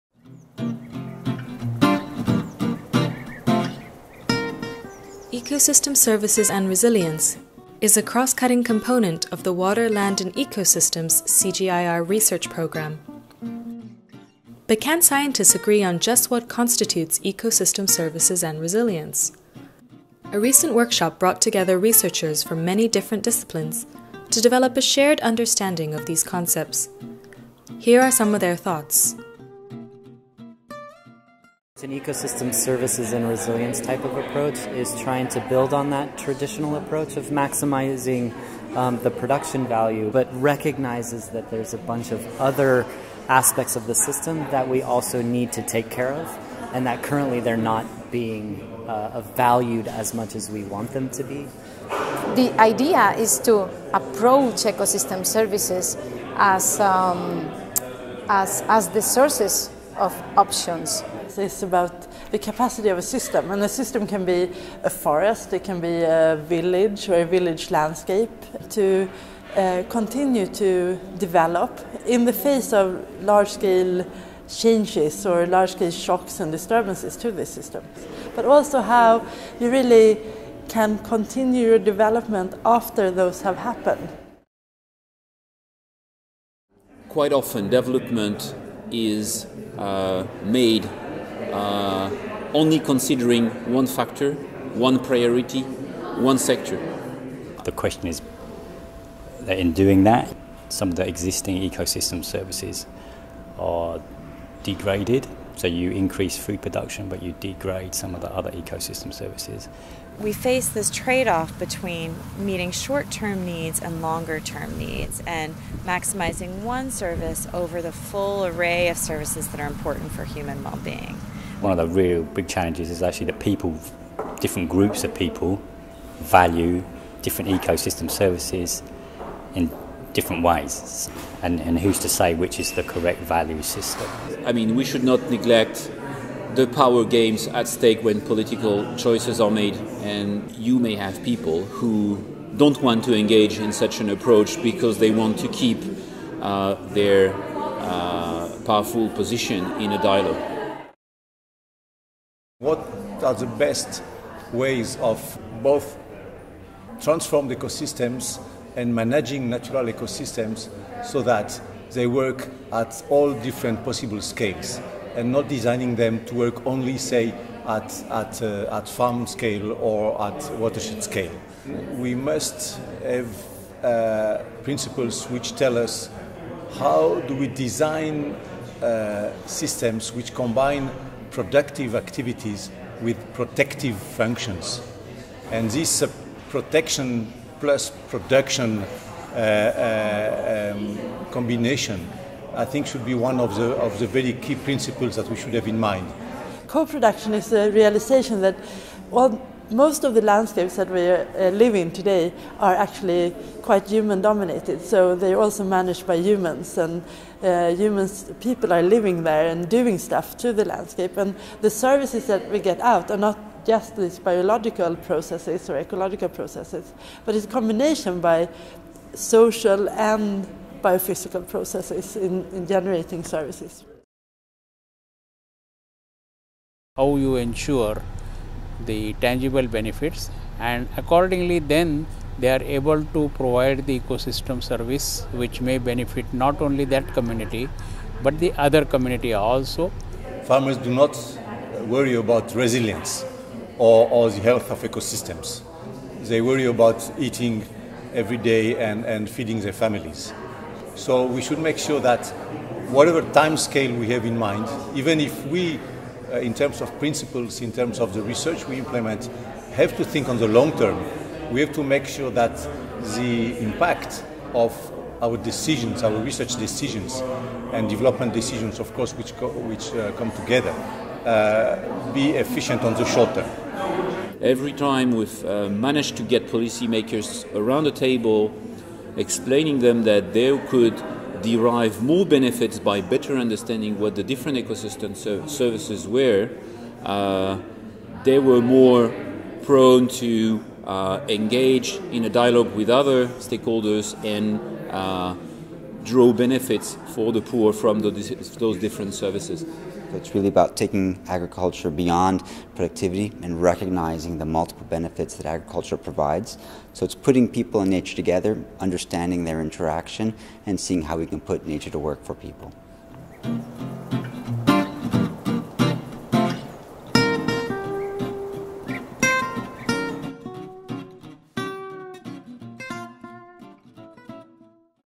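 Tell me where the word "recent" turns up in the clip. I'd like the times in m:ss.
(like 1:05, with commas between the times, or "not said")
0:20.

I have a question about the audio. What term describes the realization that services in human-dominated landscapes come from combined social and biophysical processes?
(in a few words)
Co-production.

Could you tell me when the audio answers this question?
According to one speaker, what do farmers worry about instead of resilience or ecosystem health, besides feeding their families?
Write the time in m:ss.
4:07.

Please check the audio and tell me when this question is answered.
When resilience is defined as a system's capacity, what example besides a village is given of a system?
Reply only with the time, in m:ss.
1:04.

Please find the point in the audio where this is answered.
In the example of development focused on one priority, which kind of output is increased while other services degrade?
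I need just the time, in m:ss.
1:46.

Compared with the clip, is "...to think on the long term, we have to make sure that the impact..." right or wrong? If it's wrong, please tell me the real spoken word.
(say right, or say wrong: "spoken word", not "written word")
right.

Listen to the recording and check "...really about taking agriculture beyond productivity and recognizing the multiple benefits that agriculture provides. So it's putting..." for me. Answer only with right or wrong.
right.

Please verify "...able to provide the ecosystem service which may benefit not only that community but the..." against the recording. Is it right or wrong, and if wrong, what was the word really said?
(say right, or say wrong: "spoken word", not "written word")
right.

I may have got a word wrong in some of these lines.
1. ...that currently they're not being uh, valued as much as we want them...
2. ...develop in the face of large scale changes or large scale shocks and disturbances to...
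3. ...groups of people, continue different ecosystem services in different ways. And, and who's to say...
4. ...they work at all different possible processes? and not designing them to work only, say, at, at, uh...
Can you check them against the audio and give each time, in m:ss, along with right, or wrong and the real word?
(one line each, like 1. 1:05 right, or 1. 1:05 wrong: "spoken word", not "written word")
1. 0:46 right
2. 1:11 right
3. 2:04 wrong: "value", not "continue"
4. 2:41 wrong: "scales", not "processes".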